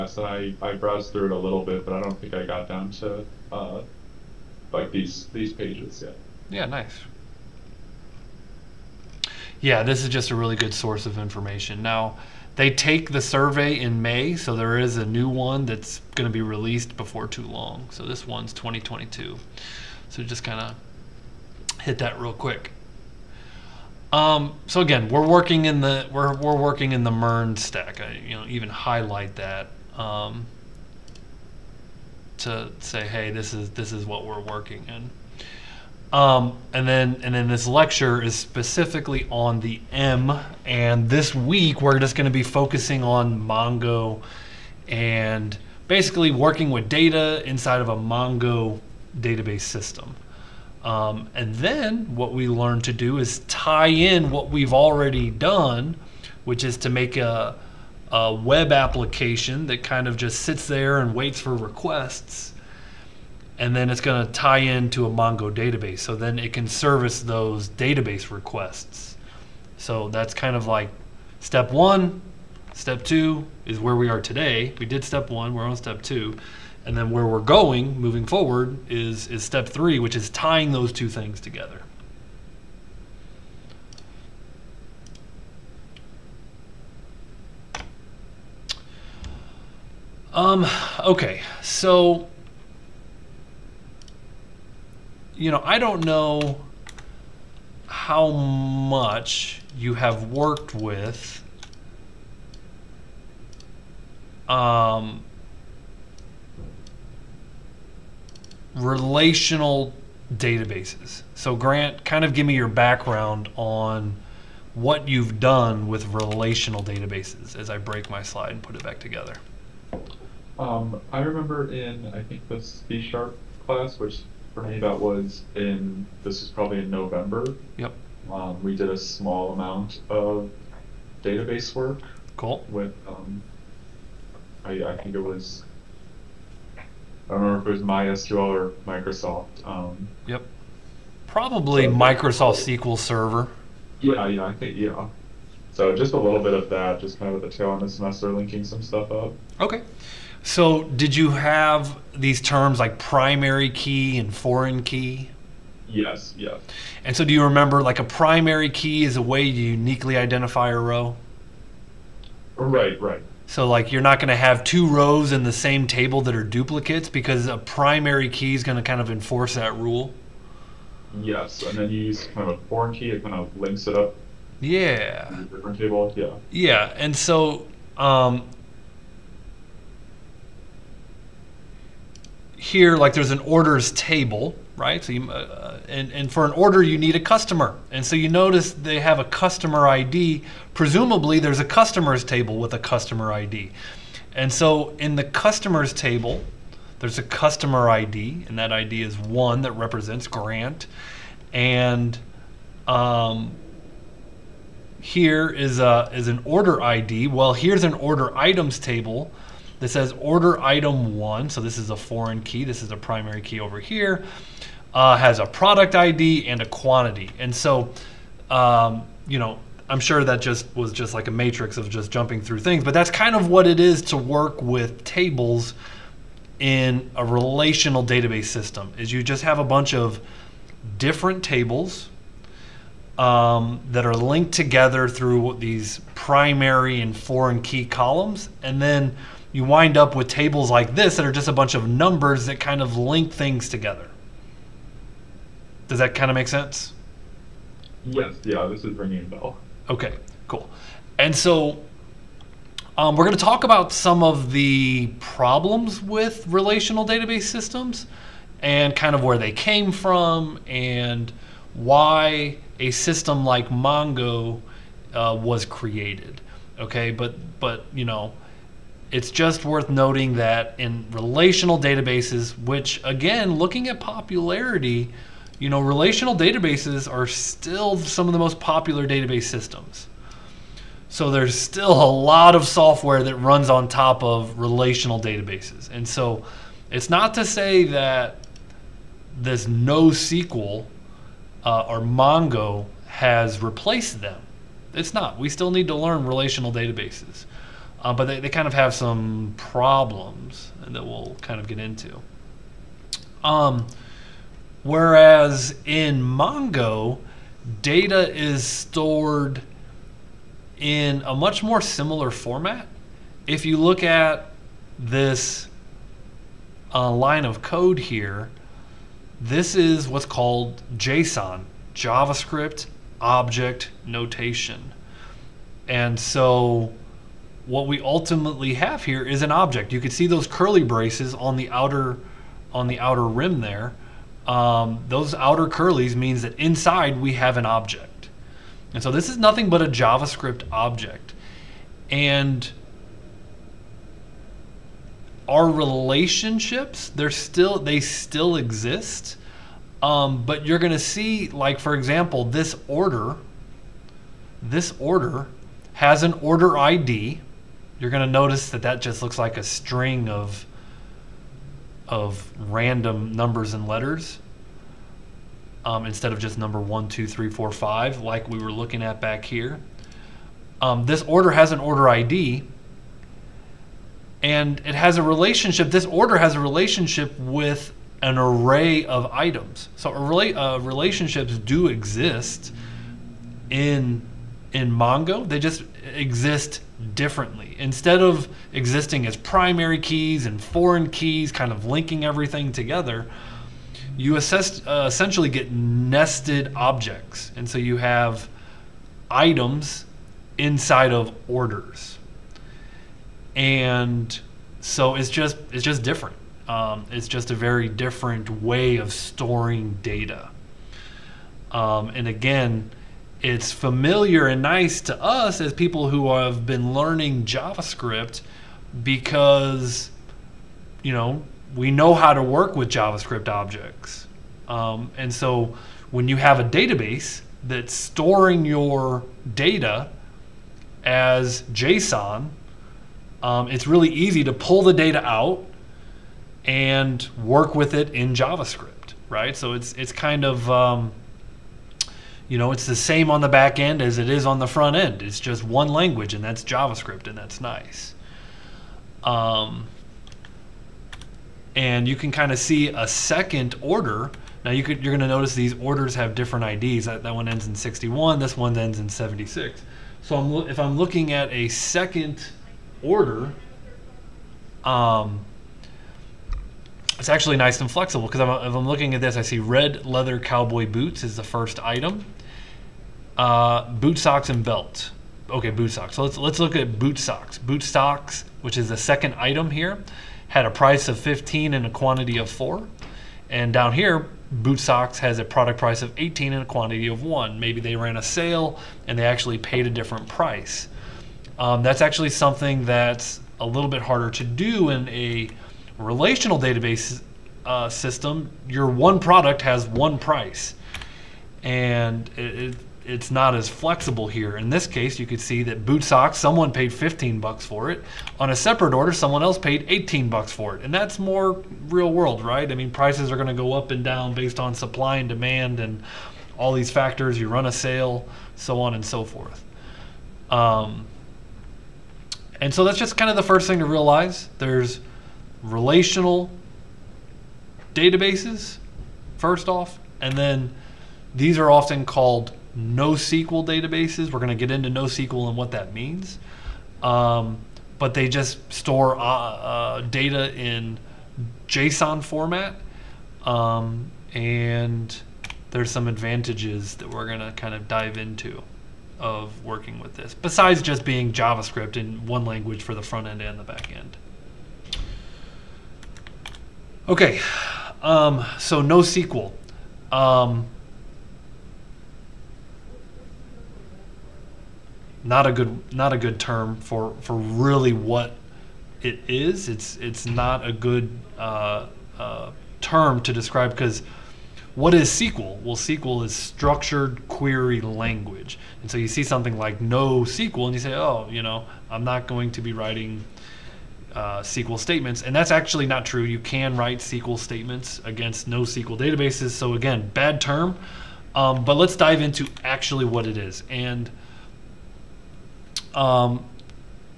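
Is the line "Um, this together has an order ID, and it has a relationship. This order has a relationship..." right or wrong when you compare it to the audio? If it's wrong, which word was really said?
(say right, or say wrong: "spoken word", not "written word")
wrong: "order", not "together".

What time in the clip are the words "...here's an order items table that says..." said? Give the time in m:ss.
3:27.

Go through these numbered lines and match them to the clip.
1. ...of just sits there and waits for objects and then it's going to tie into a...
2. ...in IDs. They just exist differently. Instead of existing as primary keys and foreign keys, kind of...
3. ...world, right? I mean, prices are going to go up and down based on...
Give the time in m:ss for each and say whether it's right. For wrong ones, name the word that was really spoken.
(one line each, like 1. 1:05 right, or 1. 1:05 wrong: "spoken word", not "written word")
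1. 1:00 wrong: "requests", not "objects"
2. 6:24 wrong: "Mongo", not "IDs"
3. 8:32 right.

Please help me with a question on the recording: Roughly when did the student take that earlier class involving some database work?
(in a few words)
November.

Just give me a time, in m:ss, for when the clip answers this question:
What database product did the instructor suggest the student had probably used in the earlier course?
2:21.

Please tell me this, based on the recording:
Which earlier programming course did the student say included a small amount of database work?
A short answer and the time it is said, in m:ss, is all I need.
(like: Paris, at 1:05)
C-sharp, at 2:02.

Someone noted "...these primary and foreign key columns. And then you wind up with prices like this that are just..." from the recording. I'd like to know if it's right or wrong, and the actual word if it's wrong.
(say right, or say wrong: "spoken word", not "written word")
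wrong: "tables", not "prices".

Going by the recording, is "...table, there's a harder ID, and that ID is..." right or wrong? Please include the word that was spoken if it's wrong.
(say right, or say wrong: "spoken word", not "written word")
wrong: "customer", not "harder".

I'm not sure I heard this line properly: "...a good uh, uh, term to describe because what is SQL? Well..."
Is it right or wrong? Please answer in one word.
right.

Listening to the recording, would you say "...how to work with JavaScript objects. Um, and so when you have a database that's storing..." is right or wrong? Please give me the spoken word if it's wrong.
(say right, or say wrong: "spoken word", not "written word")
right.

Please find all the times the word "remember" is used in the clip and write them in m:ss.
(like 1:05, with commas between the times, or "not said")
2:01, 2:17, 2:37.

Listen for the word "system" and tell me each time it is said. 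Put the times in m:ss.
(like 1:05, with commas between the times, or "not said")
0:49, 3:48, 4:17, 4:22, 4:39, 8:17.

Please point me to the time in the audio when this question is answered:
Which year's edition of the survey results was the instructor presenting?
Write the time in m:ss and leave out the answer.
0:18.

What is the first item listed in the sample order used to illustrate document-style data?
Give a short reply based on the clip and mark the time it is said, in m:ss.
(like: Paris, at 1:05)
red leather cowboy boots, at 7:49.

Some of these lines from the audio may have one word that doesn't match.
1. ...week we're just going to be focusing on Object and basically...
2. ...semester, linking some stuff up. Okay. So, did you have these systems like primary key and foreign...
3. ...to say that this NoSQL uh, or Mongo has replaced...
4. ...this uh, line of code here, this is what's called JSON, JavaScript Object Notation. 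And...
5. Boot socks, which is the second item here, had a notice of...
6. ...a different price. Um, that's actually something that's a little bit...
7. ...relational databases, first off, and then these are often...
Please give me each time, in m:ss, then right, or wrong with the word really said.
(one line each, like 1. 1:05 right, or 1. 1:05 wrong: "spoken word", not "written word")
1. 0:41 wrong: "Mongo", not "Object"
2. 2:27 wrong: "terms", not "systems"
3. 4:47 right
4. 5:14 right
5. 7:57 wrong: "price", not "notice"
6. 8:09 right
7. 8:45 right.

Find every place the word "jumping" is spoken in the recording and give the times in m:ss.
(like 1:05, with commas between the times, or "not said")
3:42.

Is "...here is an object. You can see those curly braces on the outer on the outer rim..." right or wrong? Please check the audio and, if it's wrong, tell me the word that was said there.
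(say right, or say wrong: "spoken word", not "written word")
right.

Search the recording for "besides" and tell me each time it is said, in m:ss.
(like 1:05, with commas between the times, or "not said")
9:10.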